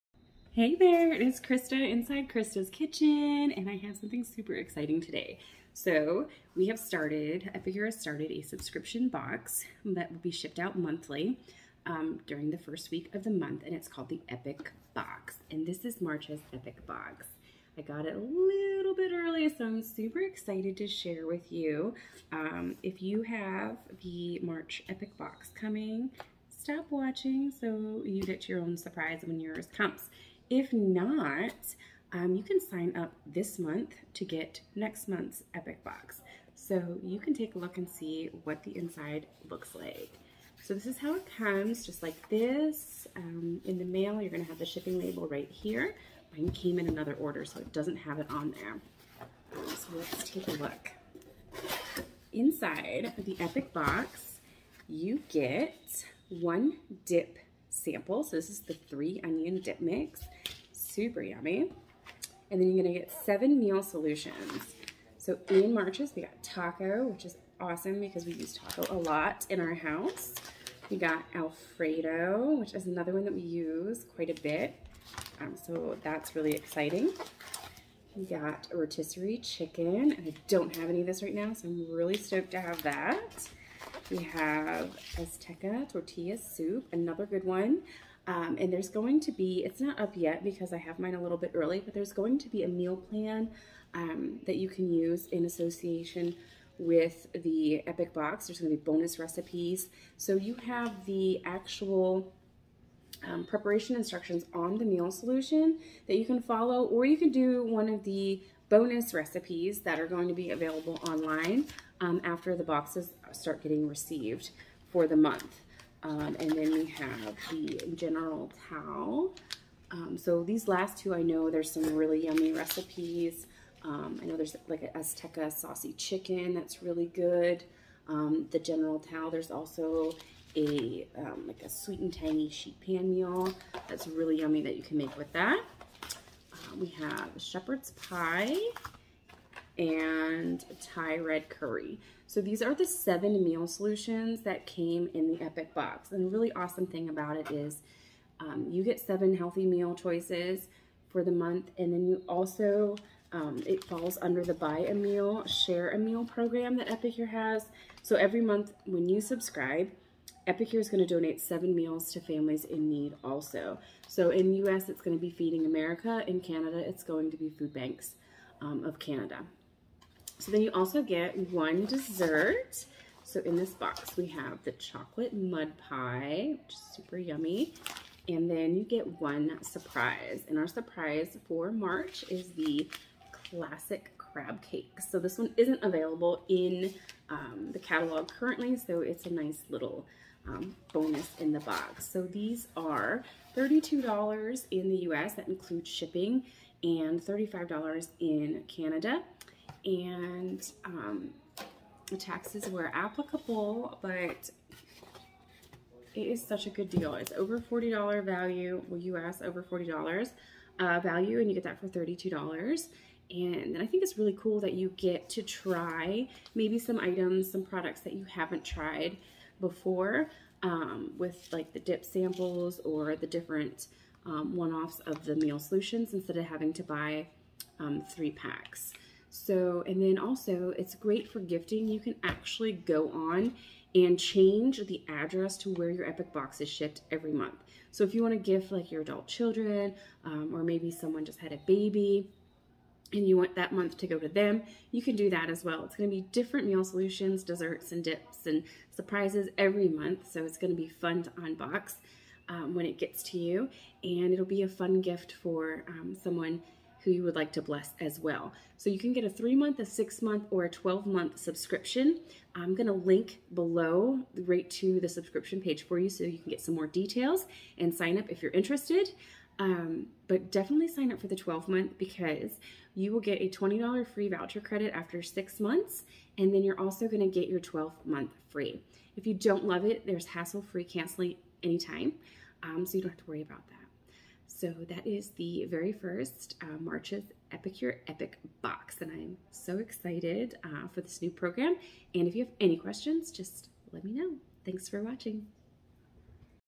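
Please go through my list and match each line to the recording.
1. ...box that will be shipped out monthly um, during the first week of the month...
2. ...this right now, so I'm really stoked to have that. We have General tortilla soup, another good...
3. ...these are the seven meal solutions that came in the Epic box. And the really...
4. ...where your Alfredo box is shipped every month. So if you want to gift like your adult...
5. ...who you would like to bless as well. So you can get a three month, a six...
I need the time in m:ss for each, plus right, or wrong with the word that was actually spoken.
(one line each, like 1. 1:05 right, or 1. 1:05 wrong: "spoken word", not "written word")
1. 0:09 right
2. 1:21 wrong: "Azteca", not "General"
3. 2:22 right
4. 3:55 wrong: "Epic", not "Alfredo"
5. 4:17 right.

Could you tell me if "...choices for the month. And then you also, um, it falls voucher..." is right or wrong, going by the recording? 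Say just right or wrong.
wrong.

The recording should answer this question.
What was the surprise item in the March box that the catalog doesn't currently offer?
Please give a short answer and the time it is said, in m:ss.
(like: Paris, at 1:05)
Classic crab cake, at 3:03.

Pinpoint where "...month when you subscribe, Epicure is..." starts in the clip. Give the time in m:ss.
2:38.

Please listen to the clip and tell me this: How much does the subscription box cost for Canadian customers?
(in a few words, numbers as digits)
$35.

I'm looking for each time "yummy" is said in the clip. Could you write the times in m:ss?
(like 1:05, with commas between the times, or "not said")
1:01, 2:02, 2:14, 2:57.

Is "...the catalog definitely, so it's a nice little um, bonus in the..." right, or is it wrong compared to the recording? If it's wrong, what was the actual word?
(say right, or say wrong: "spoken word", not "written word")
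wrong: "currently", not "definitely".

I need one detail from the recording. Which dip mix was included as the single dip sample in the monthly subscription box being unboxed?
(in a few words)
Three onion dip mix.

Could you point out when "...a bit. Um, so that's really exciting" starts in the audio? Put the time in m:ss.
1:14.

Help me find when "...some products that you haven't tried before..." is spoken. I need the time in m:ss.
3:37.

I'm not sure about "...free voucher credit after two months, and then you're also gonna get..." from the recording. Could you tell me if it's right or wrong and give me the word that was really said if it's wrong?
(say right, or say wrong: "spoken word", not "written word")
wrong: "six", not "two".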